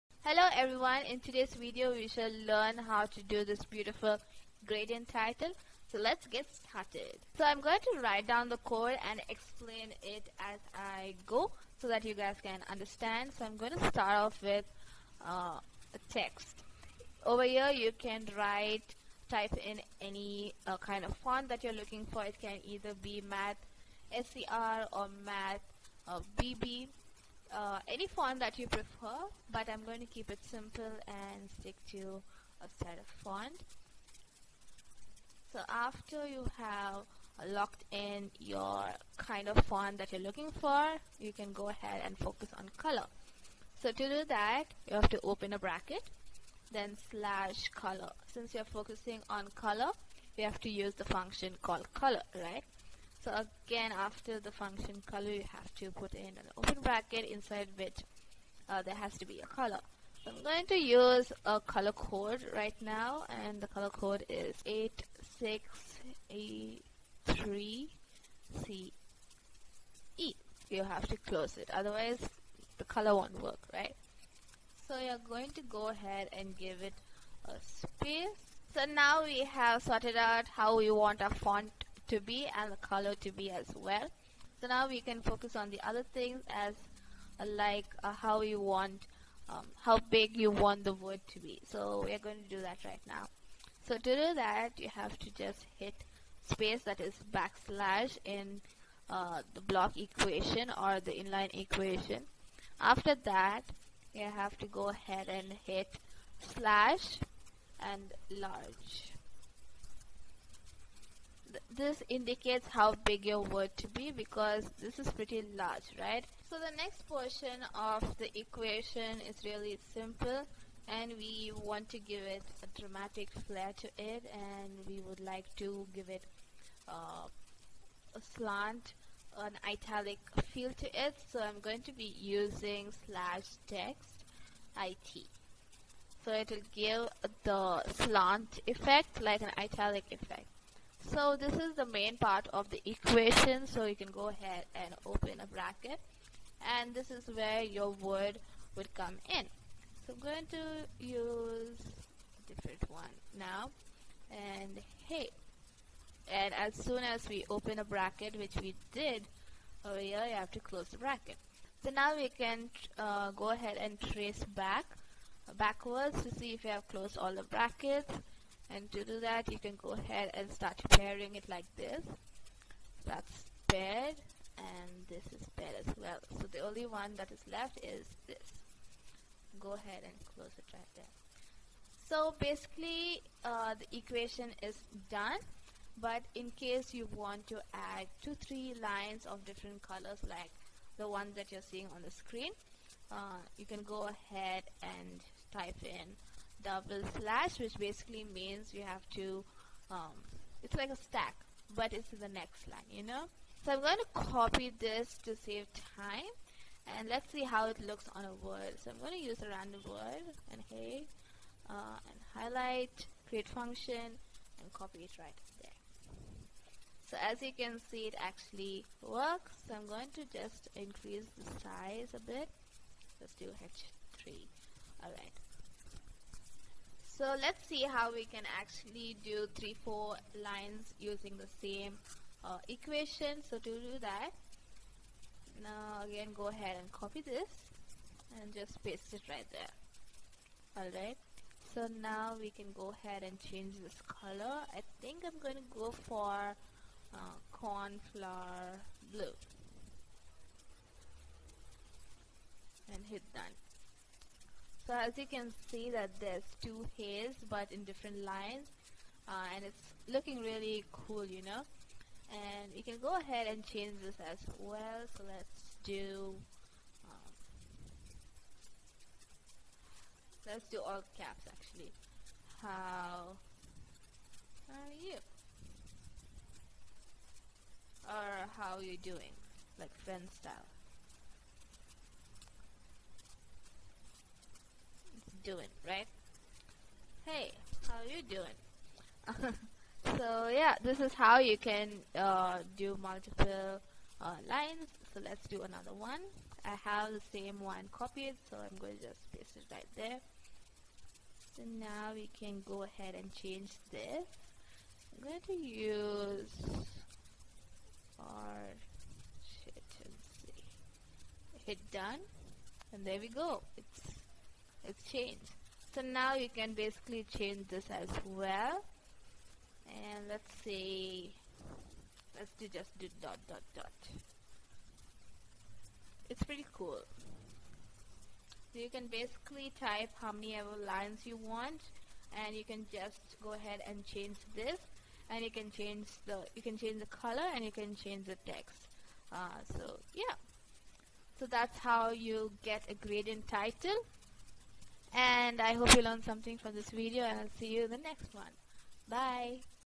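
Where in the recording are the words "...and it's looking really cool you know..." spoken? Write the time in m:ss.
4:19.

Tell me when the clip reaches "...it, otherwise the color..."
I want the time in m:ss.
1:11.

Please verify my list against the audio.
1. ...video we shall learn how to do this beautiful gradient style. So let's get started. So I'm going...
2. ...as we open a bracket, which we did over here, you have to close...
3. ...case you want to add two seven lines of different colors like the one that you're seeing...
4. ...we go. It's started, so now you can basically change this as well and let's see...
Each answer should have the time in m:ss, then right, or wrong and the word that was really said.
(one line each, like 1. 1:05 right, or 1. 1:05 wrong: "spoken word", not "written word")
1. 0:01 wrong: "title", not "style"
2. 2:37 right
3. 3:06 wrong: "three", not "seven"
4. 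5:13 wrong: "changed", not "started".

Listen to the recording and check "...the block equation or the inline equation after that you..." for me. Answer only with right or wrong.
right.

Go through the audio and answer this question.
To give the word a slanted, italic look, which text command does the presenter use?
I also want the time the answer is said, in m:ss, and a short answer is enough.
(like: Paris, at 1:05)
text IT, at 2:13.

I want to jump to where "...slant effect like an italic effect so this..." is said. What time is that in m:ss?
2:17.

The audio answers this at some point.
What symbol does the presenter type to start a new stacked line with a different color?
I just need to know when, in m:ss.
3:16.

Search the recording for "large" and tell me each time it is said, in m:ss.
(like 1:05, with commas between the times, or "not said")
1:48, 1:55.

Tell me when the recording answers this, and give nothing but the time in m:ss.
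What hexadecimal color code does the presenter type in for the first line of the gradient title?
1:04.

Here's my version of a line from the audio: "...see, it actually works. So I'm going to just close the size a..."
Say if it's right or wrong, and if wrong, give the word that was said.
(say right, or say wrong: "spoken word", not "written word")
wrong: "increase", not "close".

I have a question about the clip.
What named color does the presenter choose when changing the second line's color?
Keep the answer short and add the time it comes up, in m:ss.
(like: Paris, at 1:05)
cornflower blue, at 4:07.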